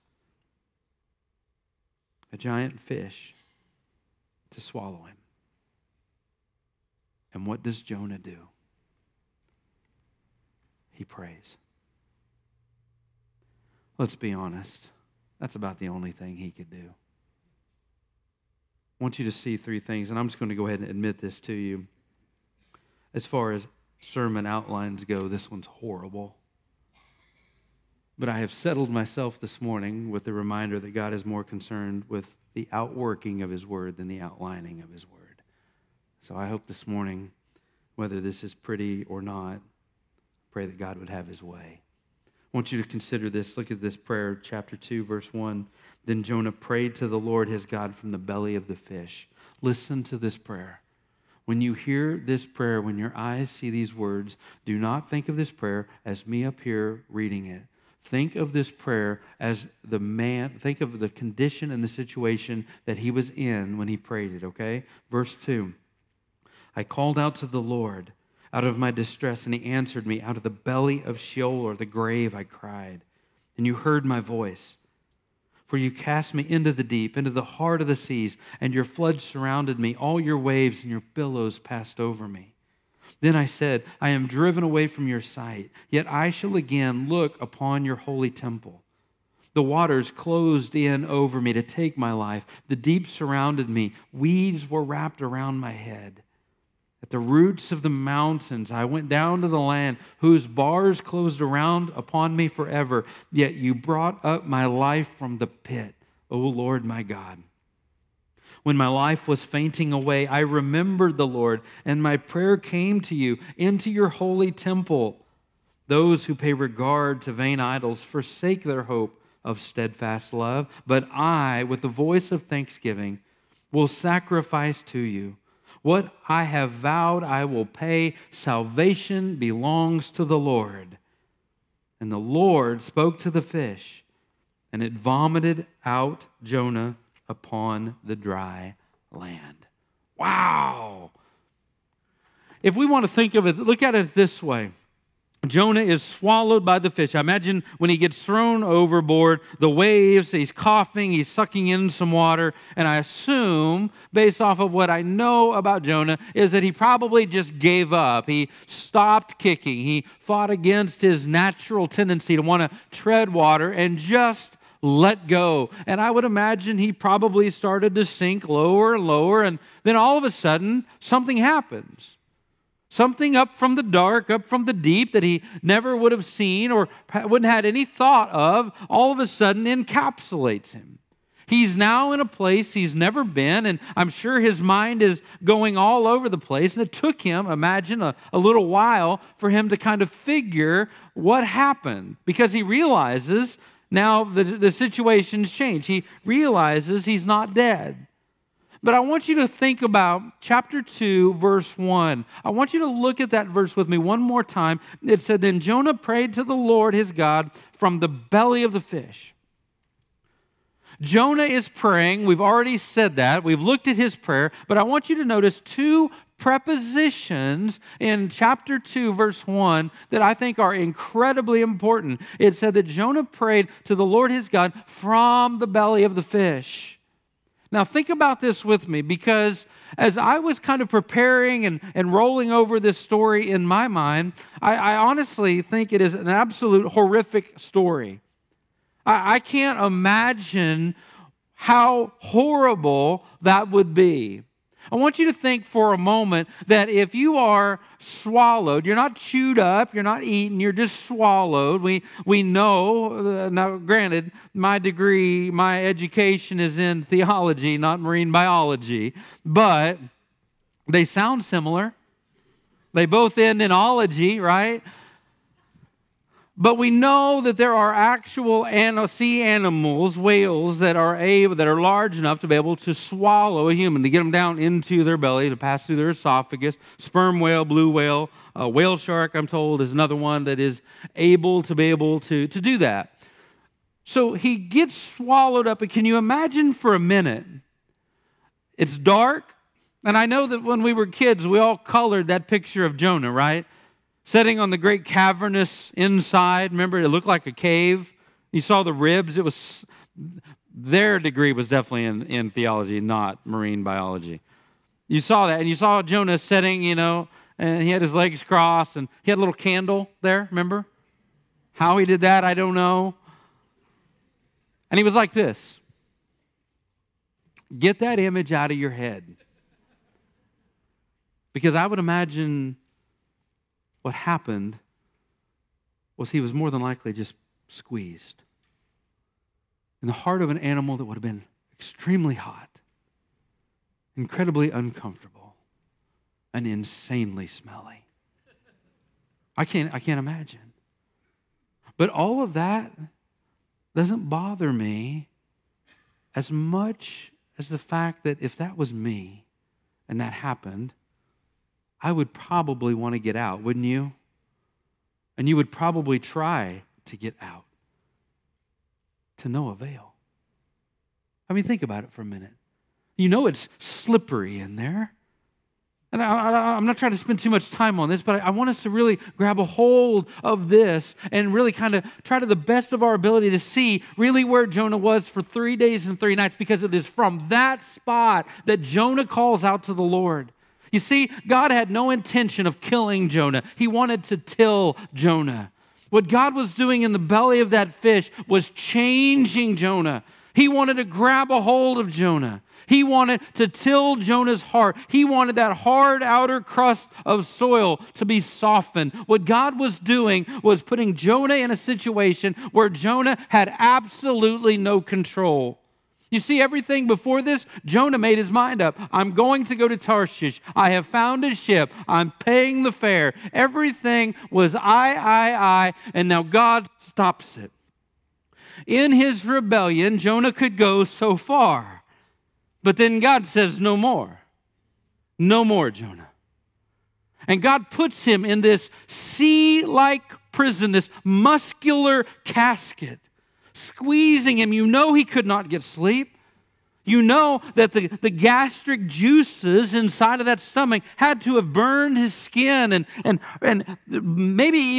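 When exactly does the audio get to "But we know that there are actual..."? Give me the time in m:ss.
4:26.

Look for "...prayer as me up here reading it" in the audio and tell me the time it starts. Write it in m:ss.
0:55.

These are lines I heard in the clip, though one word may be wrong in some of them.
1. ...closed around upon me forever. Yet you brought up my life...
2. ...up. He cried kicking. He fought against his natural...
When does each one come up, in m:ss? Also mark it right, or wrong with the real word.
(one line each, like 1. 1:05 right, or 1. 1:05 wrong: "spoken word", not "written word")
1. 1:40 right
2. 2:37 wrong: "stopped", not "cried".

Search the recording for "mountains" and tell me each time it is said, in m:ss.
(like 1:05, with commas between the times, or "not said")
1:37.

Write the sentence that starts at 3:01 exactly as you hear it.
He's now in a place he's never been, and I'm sure his mind is going all over the place.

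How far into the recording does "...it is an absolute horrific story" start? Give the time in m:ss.
3:55.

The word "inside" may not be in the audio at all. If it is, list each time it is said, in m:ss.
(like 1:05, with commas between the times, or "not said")
4:55, 7:19.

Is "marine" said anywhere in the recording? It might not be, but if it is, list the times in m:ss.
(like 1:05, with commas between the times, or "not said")
4:17, 5:03.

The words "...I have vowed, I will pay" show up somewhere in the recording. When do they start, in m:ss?
2:06.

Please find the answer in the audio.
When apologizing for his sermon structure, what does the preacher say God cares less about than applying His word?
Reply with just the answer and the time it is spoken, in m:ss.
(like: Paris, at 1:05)
Outlining, at 0:34.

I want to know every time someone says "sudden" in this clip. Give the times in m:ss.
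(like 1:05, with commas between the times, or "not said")
2:50, 2:59.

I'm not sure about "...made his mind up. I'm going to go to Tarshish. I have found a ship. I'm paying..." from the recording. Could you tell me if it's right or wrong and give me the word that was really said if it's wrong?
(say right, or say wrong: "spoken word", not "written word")
right.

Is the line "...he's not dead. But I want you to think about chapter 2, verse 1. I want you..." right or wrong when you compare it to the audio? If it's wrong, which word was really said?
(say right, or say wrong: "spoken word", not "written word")
right.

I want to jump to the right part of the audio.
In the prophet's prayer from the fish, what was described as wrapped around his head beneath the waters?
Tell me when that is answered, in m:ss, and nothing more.
1:34.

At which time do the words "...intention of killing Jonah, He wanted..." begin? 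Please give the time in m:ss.
6:22.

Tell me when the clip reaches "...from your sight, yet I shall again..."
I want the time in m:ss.
1:24.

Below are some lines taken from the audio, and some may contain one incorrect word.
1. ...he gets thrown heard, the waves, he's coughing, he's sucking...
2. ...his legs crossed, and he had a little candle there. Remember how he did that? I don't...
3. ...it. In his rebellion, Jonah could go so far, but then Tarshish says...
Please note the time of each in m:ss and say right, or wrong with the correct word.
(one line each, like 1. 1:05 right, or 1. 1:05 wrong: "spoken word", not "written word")
1. 2:27 wrong: "overboard", not "heard"
2. 5:07 right
3. 6:57 wrong: "God", not "Tarshish".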